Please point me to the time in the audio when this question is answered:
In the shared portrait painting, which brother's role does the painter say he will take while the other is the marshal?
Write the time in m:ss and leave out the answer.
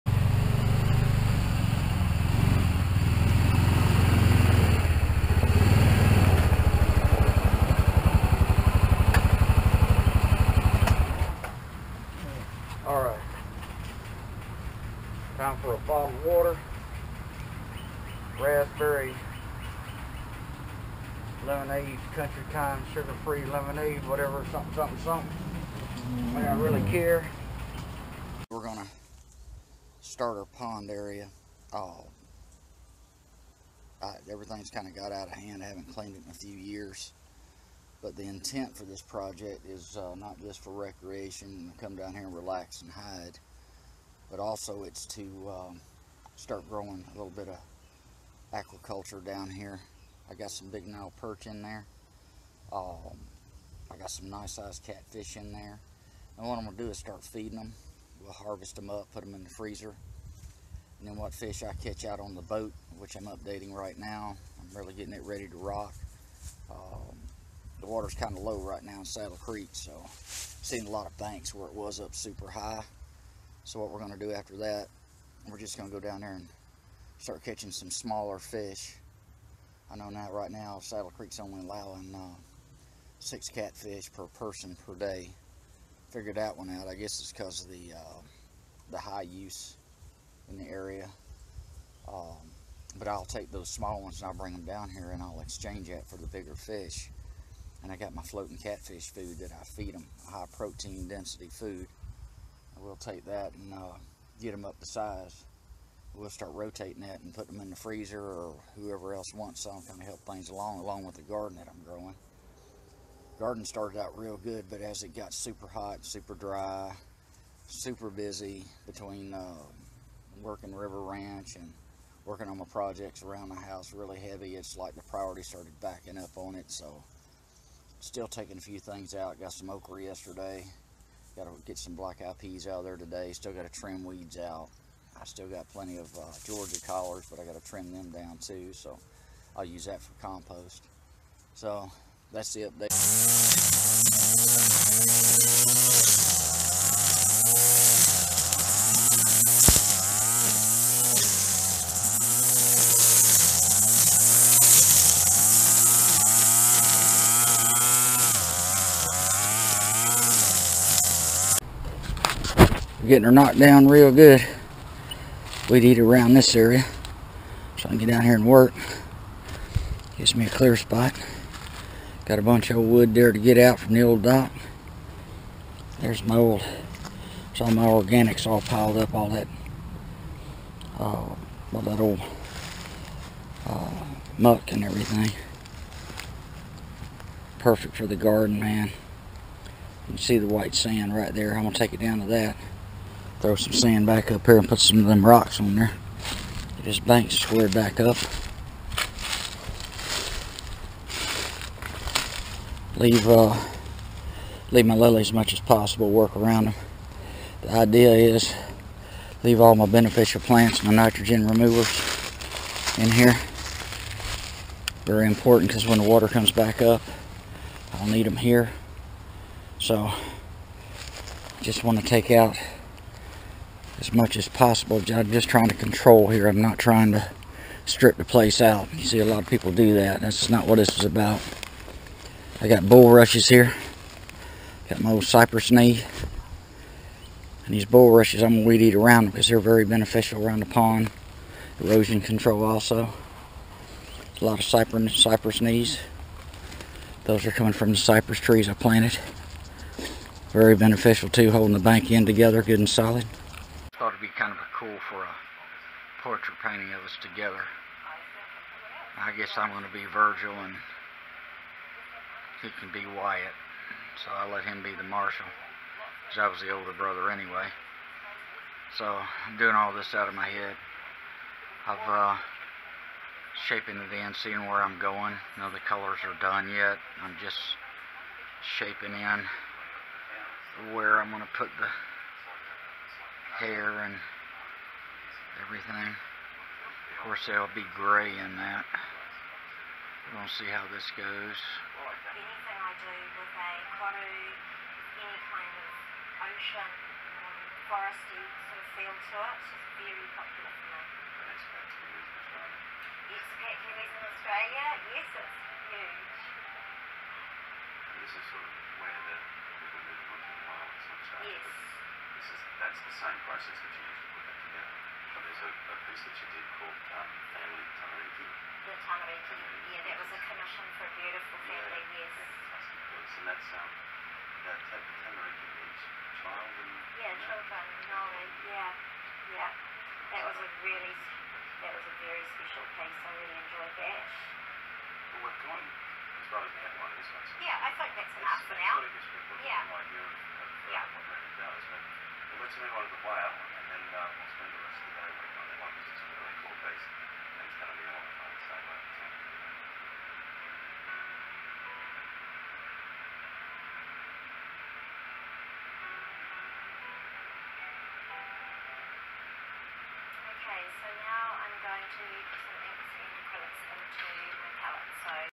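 4:20.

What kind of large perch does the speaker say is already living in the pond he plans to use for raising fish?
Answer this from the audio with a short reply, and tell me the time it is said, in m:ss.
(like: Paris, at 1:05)
Nile perch, at 0:50.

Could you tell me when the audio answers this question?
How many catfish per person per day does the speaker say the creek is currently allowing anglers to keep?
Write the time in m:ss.
1:23.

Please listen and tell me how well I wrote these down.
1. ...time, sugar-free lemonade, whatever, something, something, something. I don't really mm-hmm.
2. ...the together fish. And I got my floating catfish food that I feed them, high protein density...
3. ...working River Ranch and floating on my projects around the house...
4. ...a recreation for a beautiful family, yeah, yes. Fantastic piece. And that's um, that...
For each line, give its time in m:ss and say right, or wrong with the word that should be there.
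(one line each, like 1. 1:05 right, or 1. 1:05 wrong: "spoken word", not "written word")
1. 0:22 right
2. 1:36 wrong: "bigger", not "together"
3. 2:00 wrong: "working", not "floating"
4. 5:20 wrong: "commission", not "recreation".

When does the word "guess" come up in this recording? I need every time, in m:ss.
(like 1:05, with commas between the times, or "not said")
1:26, 4:19.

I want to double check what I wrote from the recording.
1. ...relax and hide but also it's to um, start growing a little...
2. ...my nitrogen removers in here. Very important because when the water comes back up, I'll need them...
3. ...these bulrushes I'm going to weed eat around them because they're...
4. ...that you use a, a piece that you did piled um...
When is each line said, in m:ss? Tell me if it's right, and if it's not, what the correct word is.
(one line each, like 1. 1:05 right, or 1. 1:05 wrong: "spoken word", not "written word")
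1. 0:42 right
2. 3:30 right
3. 3:57 right
4. 5:13 wrong: "called", not "piled".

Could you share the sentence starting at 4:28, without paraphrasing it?
So I'm doing all this out of my head.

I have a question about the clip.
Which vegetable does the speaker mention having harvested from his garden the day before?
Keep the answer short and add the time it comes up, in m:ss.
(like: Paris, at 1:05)
Okra, at 2:09.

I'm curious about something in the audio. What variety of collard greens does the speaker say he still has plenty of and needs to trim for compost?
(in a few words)
Georgia collards.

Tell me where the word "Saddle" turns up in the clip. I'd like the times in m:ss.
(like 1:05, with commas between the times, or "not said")
1:09, 1:20.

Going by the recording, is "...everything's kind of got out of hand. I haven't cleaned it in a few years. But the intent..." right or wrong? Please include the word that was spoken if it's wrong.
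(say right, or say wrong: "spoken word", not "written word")
right.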